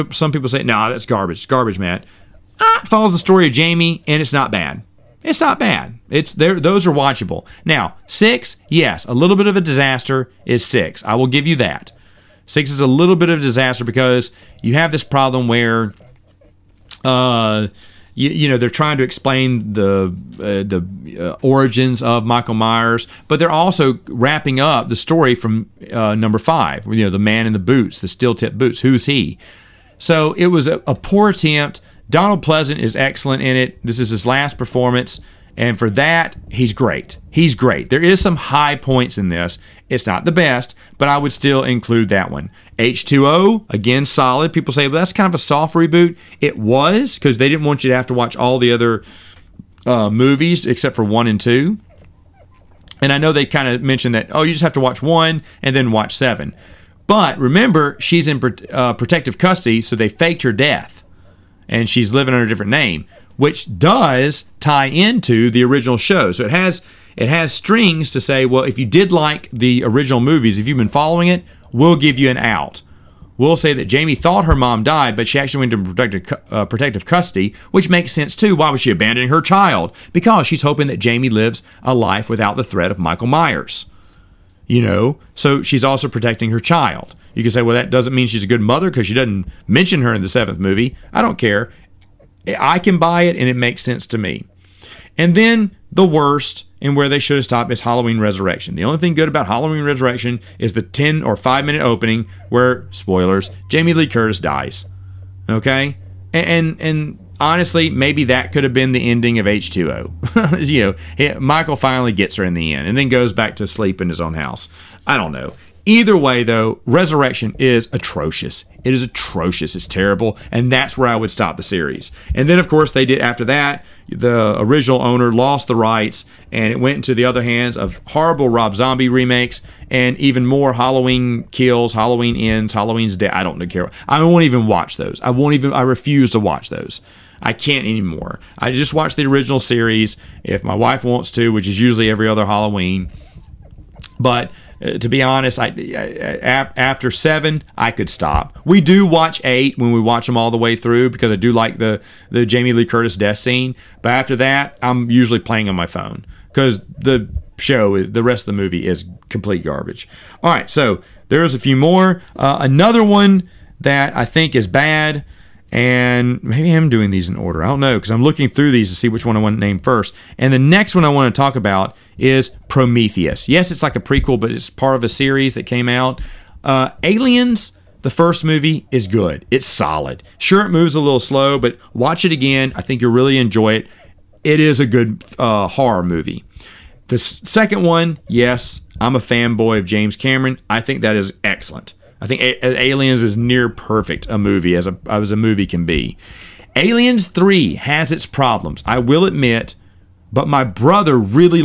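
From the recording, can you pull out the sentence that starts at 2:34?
But after that, I'm usually playing on my phone because the show the rest of the movie is complete garbage.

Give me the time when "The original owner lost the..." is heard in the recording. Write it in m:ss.
2:04.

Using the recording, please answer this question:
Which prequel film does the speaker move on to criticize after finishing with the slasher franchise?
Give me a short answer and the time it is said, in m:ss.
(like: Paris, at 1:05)
Prometheus, at 2:52.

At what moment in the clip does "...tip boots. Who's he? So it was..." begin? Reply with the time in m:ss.
0:28.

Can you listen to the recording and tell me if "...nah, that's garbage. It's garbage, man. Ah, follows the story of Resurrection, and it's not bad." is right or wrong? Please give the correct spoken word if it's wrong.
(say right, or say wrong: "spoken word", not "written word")
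wrong: "Jamie", not "Resurrection".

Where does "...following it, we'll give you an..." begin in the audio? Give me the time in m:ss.
1:10.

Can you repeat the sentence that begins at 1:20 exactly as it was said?
Because she's hoping that Jamie lives a life without the threat of Michael Myers.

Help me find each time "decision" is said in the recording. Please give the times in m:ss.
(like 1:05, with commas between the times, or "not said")
not said.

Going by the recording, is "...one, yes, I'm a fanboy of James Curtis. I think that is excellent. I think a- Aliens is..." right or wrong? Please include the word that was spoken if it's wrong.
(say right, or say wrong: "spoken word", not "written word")
wrong: "Cameron", not "Curtis".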